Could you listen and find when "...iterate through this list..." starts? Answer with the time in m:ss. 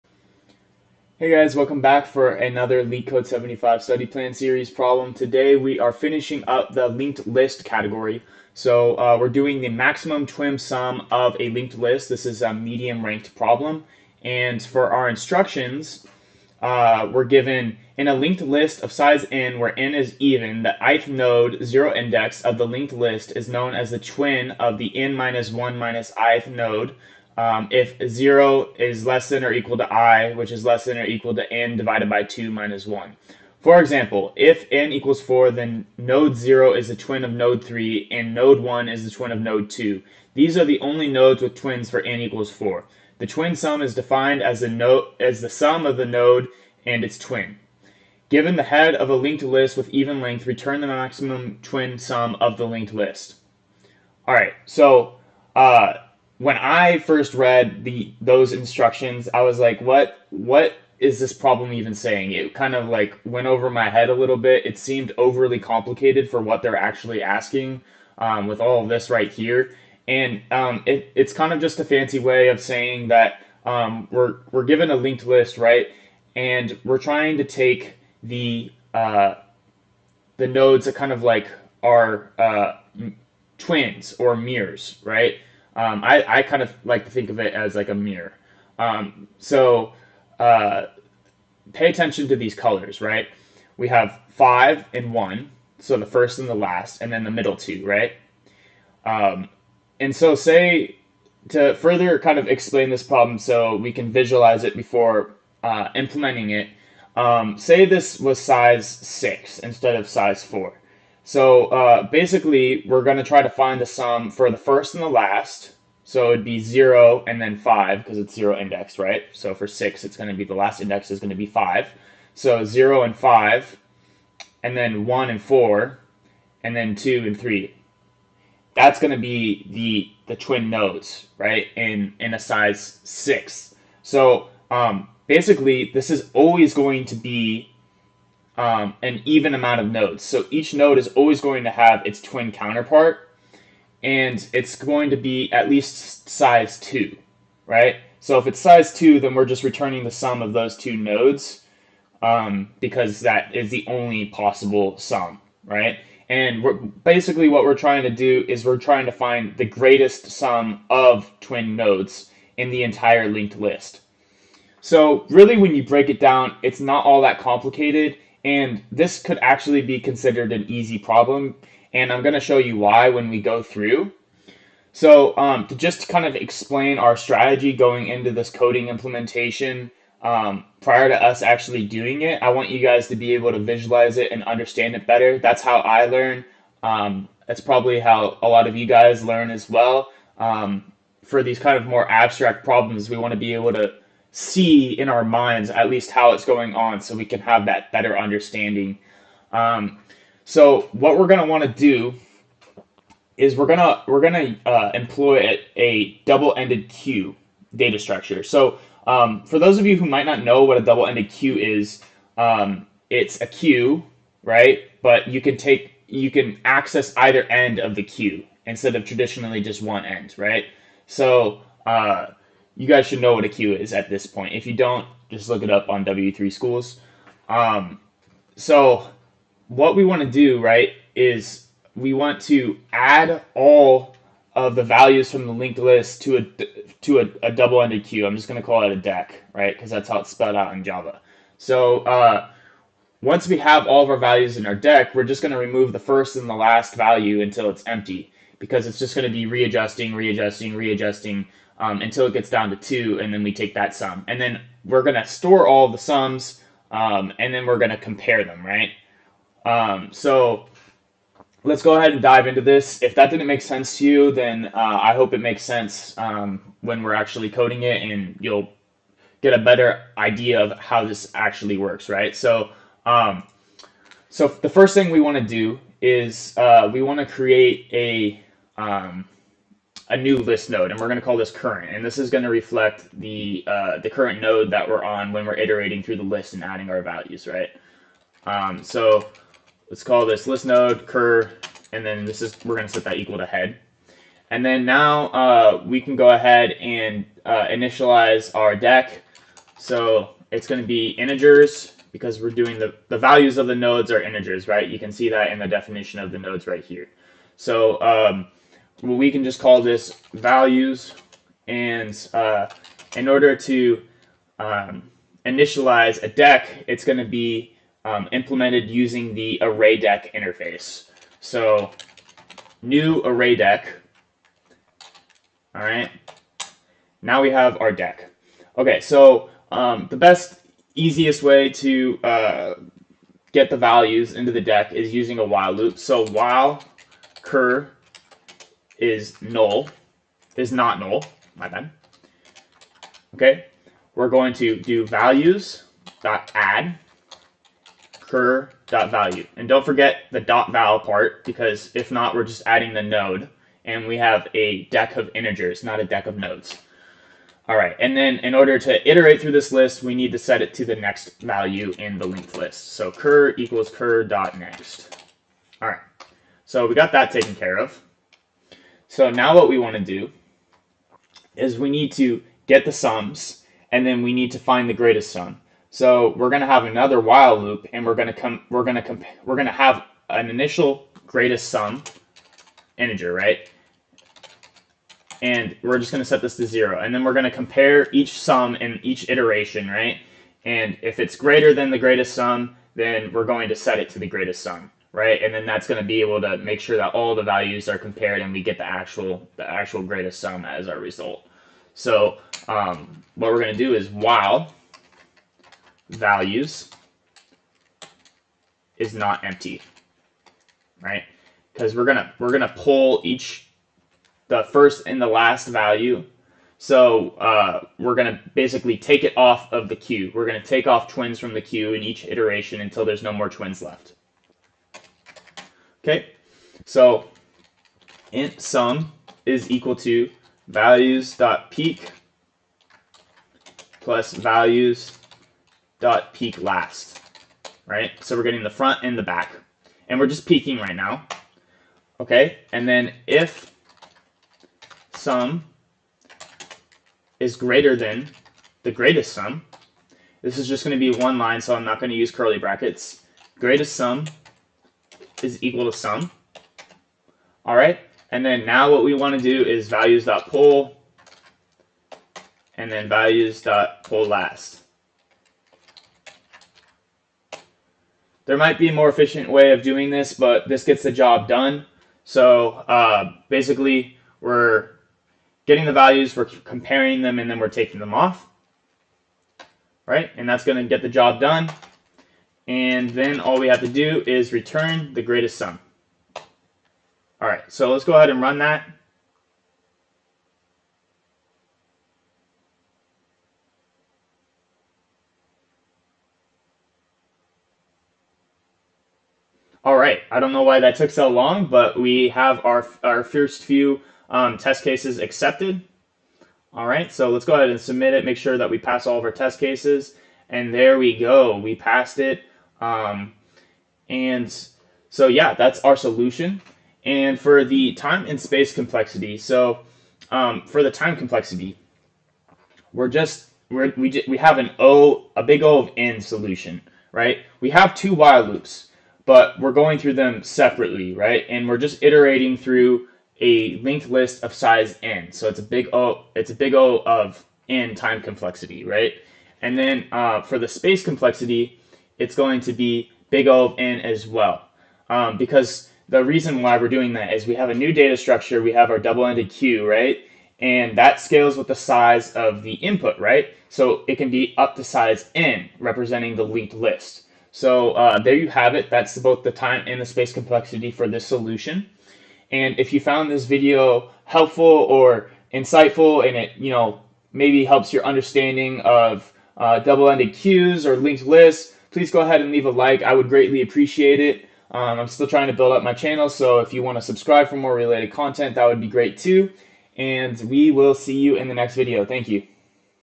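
5:59.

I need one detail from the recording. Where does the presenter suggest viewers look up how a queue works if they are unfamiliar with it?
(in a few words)
W3 Schools.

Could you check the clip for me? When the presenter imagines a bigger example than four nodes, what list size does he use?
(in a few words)
6.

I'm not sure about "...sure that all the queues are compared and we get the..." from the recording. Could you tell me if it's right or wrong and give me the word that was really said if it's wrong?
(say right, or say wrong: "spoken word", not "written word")
wrong: "values", not "queues".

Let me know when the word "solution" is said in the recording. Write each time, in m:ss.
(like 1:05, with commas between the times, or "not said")
8:35, 8:46, 9:21.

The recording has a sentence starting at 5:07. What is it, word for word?
So um, well, we can just call this values.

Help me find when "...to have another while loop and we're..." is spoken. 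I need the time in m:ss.
6:16.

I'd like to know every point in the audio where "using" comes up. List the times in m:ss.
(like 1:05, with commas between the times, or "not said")
5:18, 5:35.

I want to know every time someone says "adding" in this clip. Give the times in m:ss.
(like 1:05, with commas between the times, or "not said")
4:46, 5:52.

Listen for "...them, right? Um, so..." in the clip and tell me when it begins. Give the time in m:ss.
4:18.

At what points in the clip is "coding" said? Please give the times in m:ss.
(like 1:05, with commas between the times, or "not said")
2:58, 4:27.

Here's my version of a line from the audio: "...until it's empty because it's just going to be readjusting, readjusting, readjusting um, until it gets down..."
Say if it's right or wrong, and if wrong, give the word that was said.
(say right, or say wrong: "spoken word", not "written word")
right.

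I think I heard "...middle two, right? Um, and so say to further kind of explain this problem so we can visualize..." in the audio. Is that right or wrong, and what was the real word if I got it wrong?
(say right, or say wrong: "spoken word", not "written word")
right.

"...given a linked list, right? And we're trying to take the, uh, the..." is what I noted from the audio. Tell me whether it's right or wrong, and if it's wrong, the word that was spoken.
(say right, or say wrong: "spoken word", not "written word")
right.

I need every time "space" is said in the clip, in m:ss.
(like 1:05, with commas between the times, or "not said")
8:38, 9:00, 9:20.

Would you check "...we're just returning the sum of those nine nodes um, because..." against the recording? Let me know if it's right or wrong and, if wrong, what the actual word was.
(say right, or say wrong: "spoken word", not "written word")
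wrong: "two", not "nine".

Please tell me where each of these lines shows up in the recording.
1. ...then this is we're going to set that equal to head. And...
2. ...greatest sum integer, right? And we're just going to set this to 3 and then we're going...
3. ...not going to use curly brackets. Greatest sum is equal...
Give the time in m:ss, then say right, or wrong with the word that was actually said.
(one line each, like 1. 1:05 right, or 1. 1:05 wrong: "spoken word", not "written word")
1. 4:52 right
2. 6:21 wrong: "0", not "3"
3. 7:31 right.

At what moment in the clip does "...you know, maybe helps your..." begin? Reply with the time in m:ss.
9:26.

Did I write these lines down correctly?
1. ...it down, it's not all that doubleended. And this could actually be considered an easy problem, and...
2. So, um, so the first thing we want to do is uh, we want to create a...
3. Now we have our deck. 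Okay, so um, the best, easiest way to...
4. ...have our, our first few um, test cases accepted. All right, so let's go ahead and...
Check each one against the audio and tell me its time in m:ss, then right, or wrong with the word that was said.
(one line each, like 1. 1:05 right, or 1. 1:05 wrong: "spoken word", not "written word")
1. 2:46 wrong: "complicated", not "doubleended"
2. 4:32 right
3. 5:27 right
4. 8:22 right.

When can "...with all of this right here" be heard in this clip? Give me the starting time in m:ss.
1:08.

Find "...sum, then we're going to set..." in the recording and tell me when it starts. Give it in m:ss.
6:32.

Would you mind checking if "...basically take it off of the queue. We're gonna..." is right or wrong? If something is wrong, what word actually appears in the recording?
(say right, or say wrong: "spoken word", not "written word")
right.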